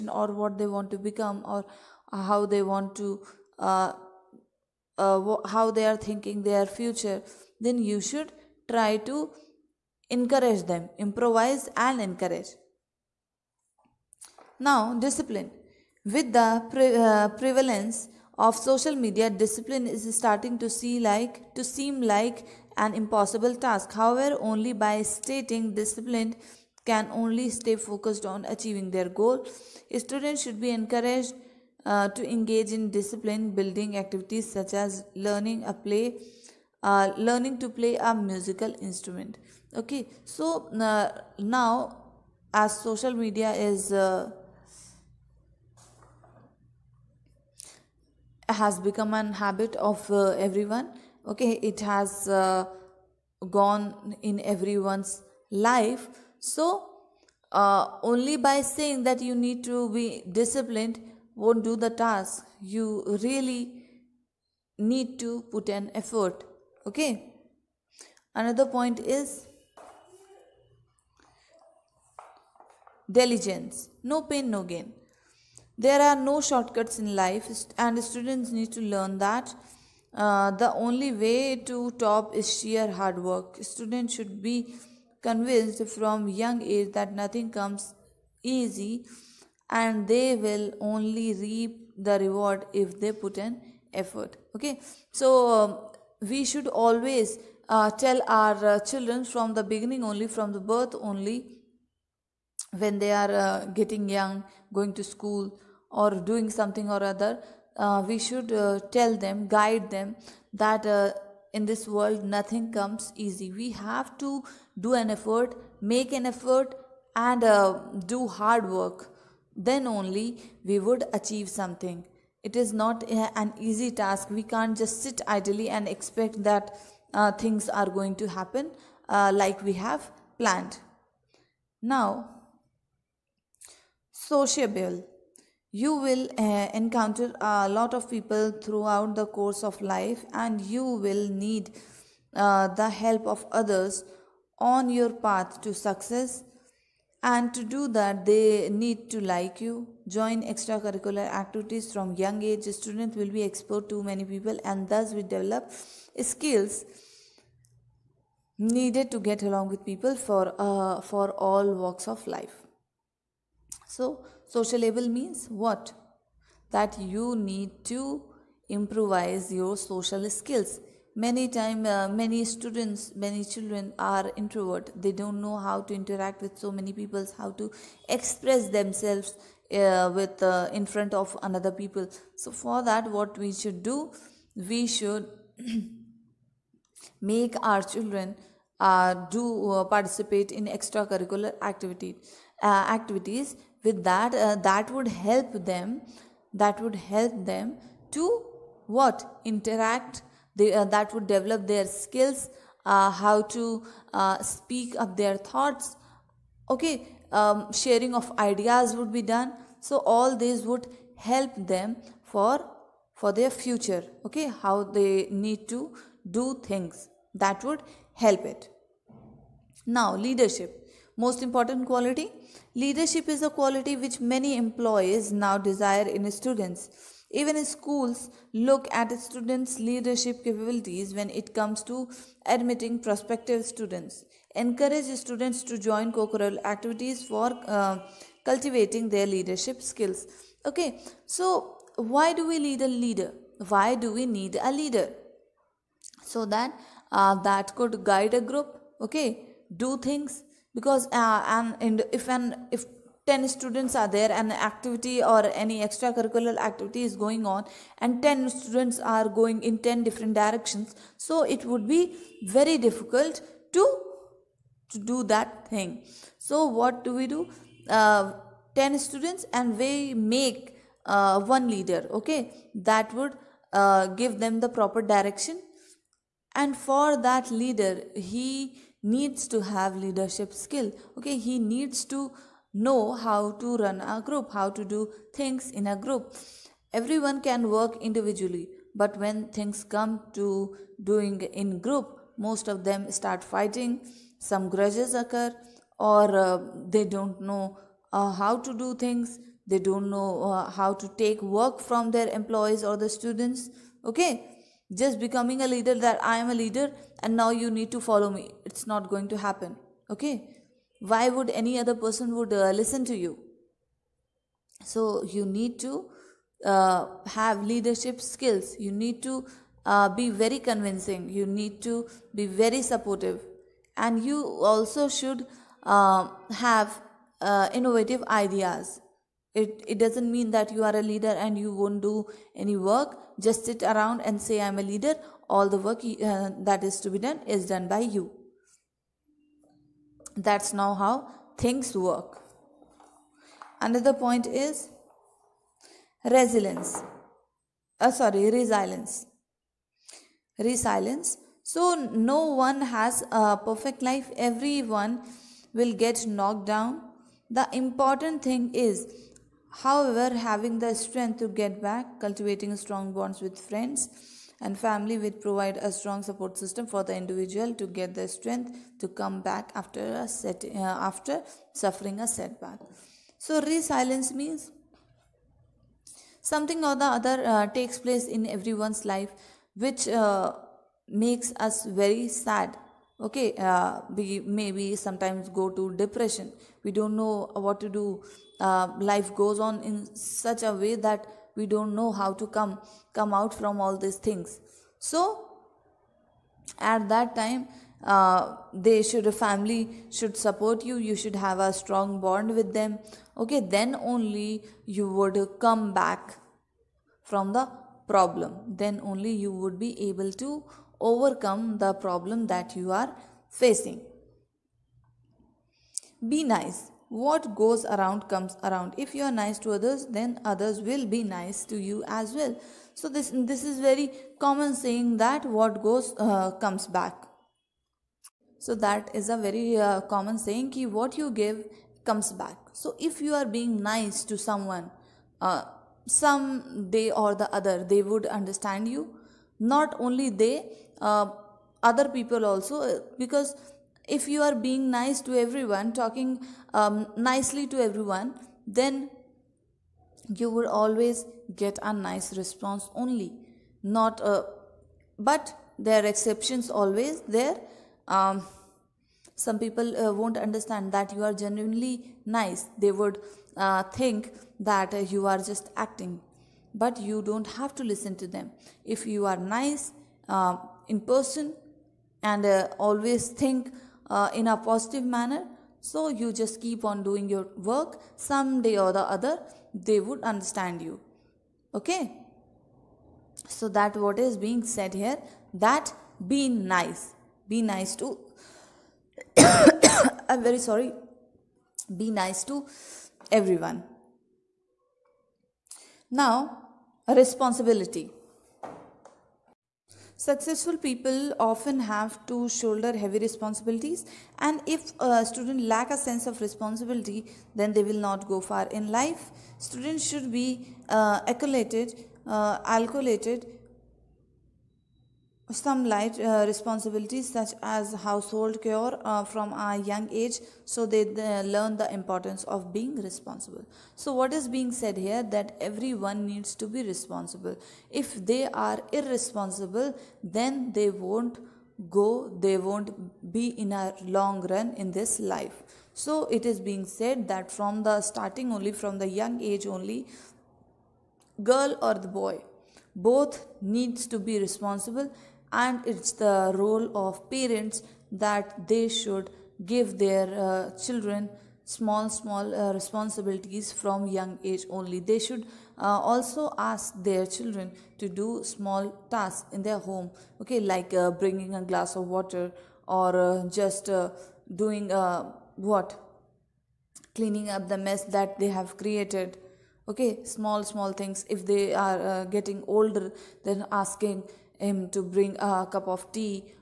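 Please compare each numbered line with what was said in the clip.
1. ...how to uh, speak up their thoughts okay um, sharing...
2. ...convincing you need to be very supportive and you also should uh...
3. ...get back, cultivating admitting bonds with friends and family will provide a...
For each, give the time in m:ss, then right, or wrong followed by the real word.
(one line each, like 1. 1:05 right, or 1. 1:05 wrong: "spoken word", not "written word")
1. 3:23 right
2. 5:20 right
3. 6:01 wrong: "strong", not "admitting".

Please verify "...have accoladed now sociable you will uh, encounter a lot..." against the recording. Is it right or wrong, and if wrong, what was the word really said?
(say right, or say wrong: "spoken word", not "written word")
wrong: "planned", not "accoladed".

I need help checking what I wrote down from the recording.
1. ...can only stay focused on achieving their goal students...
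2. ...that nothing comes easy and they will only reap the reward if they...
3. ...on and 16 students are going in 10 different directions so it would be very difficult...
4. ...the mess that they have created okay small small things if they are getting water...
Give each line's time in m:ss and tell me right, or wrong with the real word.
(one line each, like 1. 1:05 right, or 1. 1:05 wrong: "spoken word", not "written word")
1. 0:26 right
2. 1:26 right
3. 4:17 wrong: "10", not "16"
4. 9:27 wrong: "older", not "water".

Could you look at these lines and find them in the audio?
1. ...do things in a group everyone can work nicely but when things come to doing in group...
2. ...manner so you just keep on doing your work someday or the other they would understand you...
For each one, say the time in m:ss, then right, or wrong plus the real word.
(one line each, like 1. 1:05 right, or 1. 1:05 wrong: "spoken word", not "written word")
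1. 4:44 wrong: "individually", not "nicely"
2. 7:55 right.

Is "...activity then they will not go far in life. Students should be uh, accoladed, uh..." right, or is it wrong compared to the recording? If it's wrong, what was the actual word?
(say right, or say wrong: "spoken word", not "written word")
wrong: "responsibility", not "activity".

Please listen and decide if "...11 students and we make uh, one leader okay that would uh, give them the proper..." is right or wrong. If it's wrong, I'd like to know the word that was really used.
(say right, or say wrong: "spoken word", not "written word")
wrong: "10", not "11".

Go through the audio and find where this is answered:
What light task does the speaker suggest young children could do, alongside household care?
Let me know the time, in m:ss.
9:21.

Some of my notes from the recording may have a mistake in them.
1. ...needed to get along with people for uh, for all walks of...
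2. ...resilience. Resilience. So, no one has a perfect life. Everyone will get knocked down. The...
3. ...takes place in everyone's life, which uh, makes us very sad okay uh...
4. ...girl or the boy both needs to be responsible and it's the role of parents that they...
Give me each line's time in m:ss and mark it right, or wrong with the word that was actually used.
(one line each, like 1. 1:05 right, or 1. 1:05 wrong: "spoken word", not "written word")
1. 2:38 right
2. 5:48 right
3. 6:17 right
4. 9:01 right.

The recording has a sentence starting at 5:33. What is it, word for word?
Just sit around and say, I'm a leader.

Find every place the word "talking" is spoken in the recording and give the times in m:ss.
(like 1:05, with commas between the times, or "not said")
7:25.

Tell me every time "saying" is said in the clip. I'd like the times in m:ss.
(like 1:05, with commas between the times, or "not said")
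0:58, 7:04, 7:10.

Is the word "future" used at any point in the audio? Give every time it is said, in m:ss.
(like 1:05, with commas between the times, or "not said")
0:06, 3:33.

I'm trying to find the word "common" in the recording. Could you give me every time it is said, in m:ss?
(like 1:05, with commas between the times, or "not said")
7:04, 7:10.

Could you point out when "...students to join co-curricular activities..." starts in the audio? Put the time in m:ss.
3:55.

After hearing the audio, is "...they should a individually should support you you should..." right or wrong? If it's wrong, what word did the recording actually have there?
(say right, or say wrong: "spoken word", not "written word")
wrong: "family", not "individually".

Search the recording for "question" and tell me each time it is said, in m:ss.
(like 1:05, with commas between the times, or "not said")
not said.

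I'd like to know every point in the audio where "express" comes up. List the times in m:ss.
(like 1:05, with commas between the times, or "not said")
2:58.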